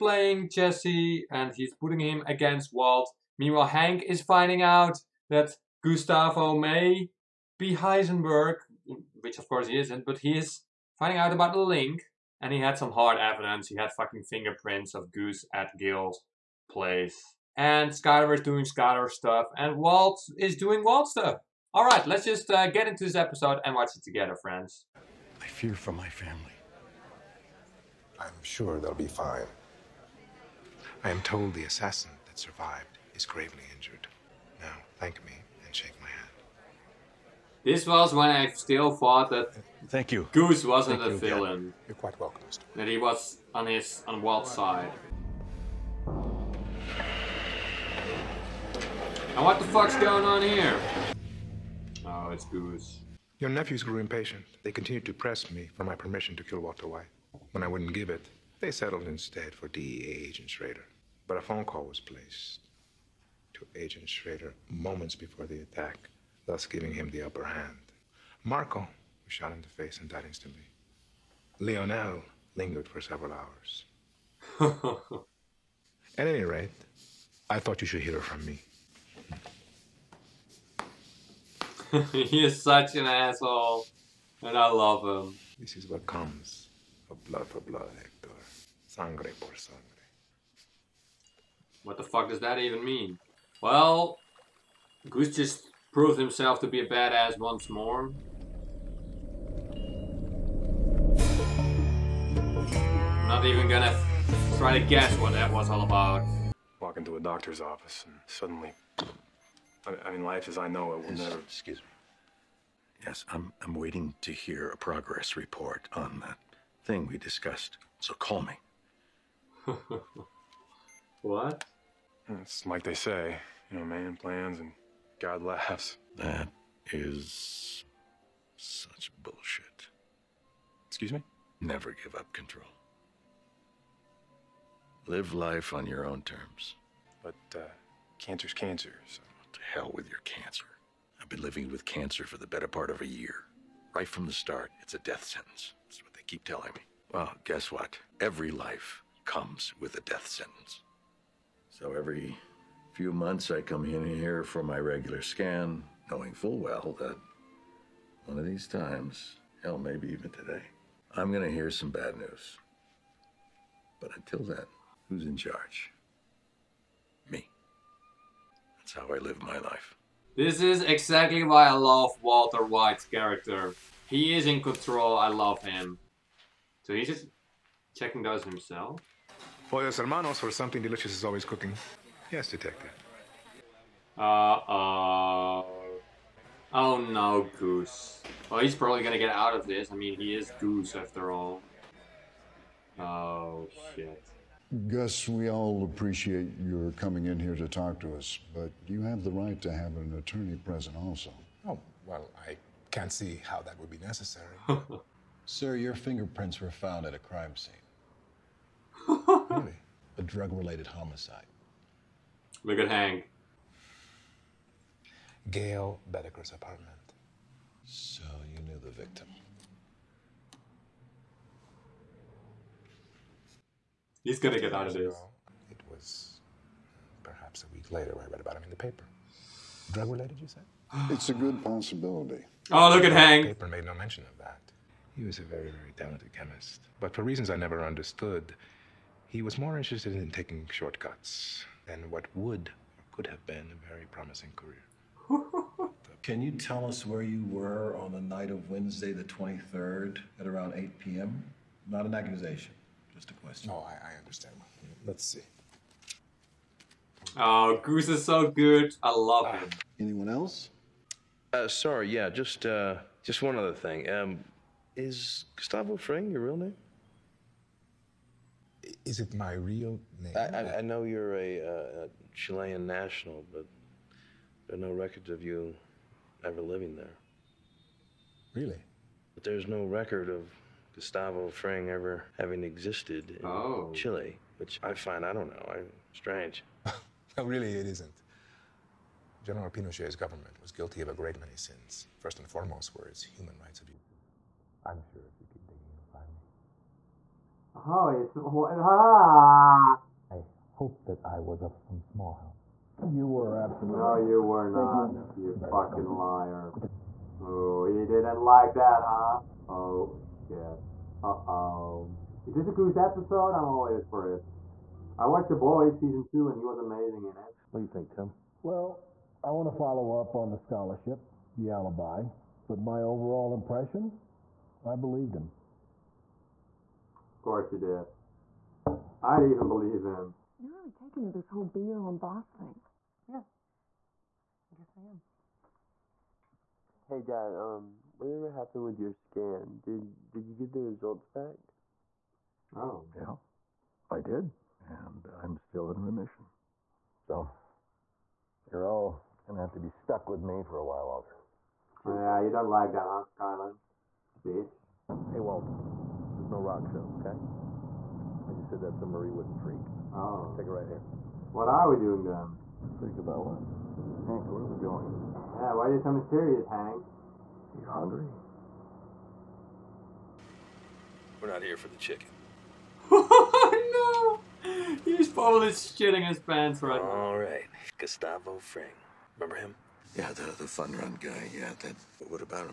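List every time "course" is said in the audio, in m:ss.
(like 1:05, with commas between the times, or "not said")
0:09, 5:27.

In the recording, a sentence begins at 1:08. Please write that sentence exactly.
Marco was shot in the face and died instantly.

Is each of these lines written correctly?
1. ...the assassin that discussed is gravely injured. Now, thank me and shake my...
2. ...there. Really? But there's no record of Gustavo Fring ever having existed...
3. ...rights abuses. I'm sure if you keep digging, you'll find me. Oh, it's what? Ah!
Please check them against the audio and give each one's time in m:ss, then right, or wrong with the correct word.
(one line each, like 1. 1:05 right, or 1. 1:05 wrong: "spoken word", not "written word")
1. 0:31 wrong: "survived", not "discussed"
2. 4:36 right
3. 4:53 right.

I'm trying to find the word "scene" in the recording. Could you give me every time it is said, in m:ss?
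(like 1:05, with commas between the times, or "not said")
3:27.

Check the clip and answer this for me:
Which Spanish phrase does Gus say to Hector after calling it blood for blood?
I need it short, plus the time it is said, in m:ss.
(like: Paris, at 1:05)
Sangre por sangre, at 1:28.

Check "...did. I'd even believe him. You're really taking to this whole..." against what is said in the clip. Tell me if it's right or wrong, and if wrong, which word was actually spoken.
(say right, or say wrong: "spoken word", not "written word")
right.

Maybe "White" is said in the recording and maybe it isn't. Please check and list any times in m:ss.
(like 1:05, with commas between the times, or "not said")
0:56, 2:52.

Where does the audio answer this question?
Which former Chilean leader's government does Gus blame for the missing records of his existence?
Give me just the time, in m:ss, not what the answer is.
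4:49.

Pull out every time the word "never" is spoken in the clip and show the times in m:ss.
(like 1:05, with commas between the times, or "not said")
1:51, 2:11, 3:57.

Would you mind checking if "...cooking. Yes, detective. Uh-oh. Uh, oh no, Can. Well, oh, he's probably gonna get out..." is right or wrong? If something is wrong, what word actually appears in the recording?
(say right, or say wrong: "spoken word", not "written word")
wrong: "Goose", not "Can".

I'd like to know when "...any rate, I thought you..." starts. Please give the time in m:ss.
1:16.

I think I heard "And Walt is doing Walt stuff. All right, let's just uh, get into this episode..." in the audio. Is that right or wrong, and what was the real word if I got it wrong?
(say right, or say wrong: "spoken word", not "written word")
right.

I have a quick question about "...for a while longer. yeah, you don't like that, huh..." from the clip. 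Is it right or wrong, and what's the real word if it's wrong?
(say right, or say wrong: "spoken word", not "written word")
right.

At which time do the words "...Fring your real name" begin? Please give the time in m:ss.
4:25.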